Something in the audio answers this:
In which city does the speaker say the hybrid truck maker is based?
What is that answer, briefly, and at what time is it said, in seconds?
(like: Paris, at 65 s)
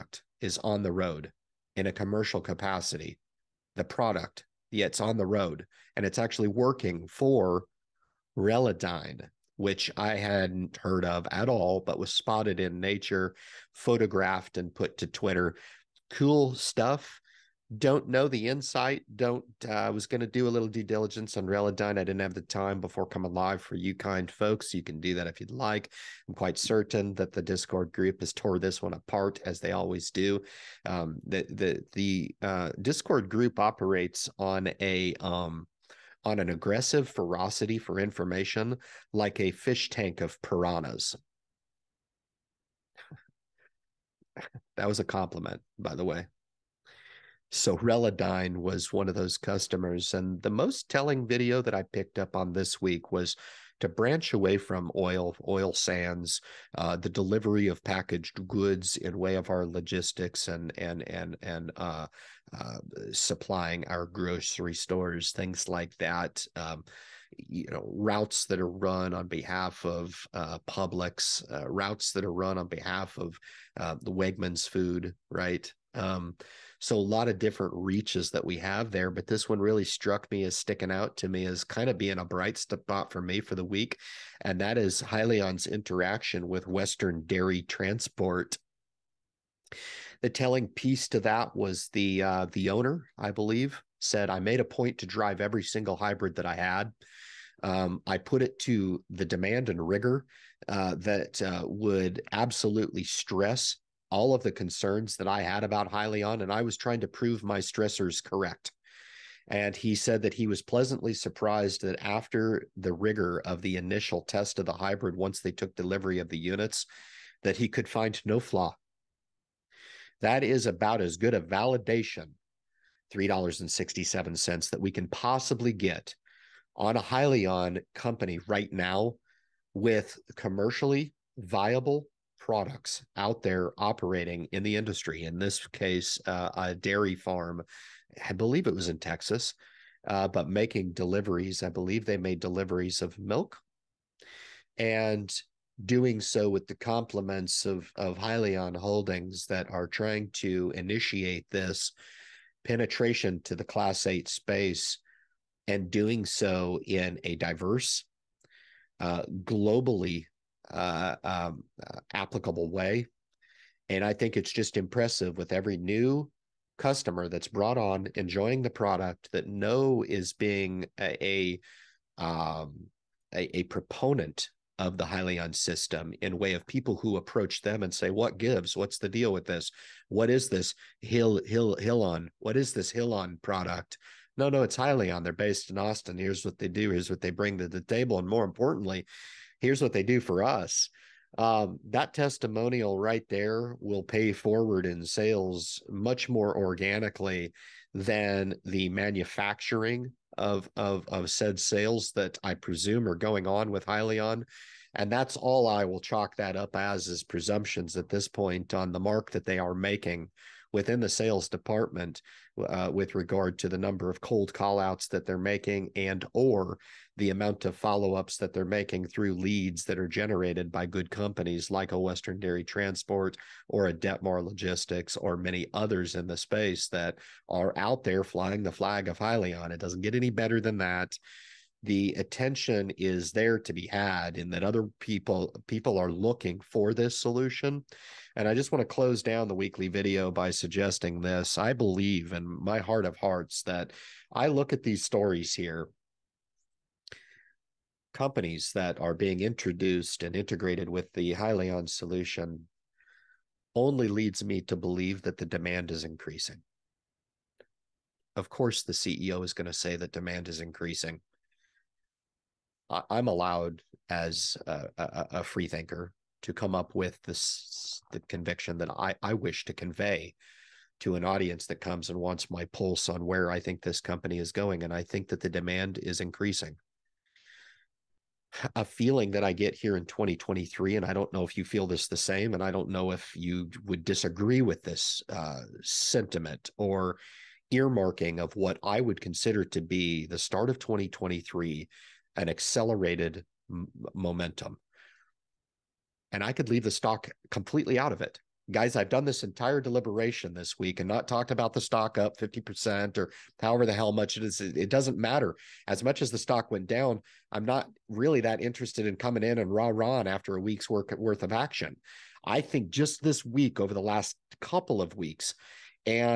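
Austin, at 185 s.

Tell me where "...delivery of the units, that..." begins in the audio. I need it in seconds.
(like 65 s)
115 s.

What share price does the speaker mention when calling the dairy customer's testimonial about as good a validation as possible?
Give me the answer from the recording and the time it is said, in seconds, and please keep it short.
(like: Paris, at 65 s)
$3.67, at 123 s.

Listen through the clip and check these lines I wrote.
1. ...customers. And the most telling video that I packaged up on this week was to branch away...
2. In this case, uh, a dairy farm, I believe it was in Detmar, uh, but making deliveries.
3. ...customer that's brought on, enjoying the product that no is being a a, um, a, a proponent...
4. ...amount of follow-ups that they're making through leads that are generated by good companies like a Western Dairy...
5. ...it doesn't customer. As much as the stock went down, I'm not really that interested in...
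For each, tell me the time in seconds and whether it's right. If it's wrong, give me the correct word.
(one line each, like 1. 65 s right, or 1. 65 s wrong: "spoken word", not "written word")
1. 49 s wrong: "picked", not "packaged"
2. 135 s wrong: "Texas", not "Detmar"
3. 166 s right
4. 217 s right
5. 304 s wrong: "matter", not "customer".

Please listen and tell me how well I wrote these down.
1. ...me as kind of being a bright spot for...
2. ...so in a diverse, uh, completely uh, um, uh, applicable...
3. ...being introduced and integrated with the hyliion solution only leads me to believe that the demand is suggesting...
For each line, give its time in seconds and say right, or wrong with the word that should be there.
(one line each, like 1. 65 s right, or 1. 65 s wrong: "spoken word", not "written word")
1. 81 s right
2. 156 s wrong: "globally", not "completely"
3. 249 s wrong: "increasing", not "suggesting".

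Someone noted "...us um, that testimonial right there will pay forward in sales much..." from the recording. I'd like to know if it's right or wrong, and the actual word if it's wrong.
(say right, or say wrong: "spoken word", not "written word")
right.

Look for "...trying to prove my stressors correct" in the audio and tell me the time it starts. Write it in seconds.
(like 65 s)
106 s.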